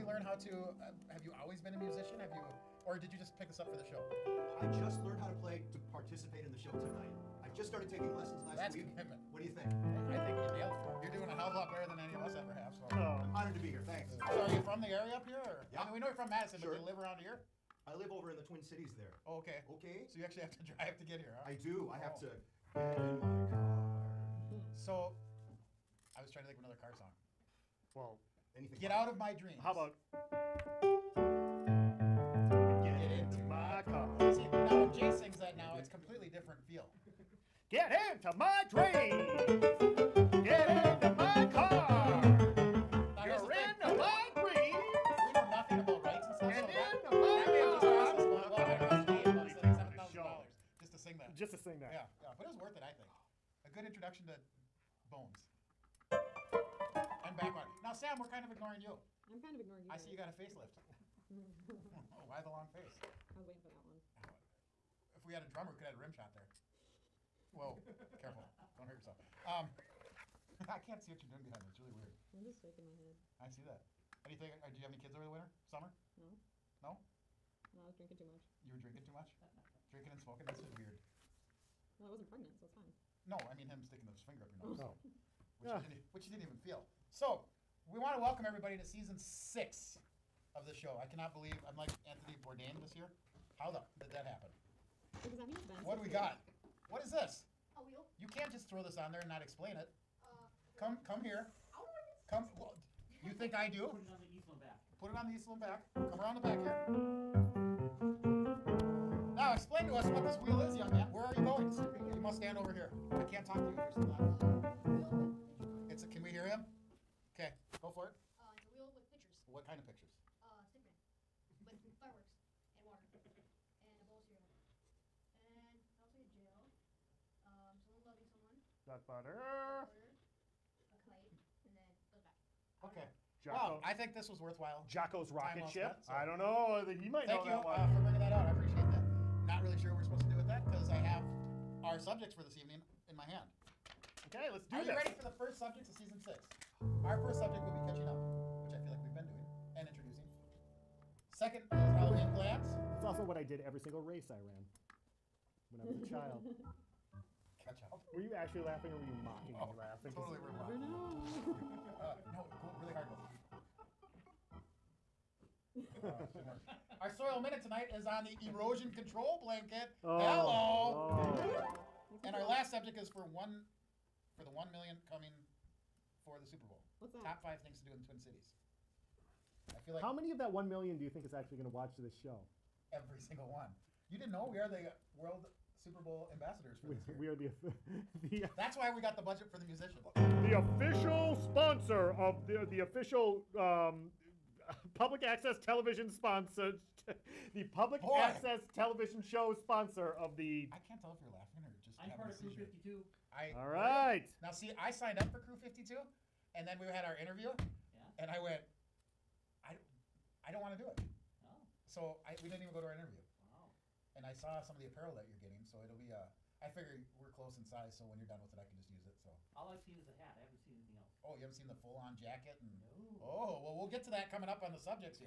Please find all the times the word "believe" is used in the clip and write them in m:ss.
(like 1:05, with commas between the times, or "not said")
1:31.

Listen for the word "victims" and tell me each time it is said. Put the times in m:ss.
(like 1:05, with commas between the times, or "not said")
not said.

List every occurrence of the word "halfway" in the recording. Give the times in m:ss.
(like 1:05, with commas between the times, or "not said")
not said.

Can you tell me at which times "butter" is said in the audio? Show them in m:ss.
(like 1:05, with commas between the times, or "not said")
2:09.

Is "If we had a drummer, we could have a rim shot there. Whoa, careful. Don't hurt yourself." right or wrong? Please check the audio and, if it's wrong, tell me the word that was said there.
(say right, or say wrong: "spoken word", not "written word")
right.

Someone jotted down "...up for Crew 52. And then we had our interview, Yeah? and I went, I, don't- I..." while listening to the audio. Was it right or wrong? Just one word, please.
right.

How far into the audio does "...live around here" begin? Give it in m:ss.
0:16.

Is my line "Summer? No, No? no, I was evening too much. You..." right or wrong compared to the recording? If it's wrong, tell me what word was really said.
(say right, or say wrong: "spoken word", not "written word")
wrong: "drinking", not "evening".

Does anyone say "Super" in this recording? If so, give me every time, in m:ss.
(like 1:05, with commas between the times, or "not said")
2:56, 3:05.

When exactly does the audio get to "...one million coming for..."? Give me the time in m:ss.
2:54.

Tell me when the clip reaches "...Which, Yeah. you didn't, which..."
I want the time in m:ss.
1:25.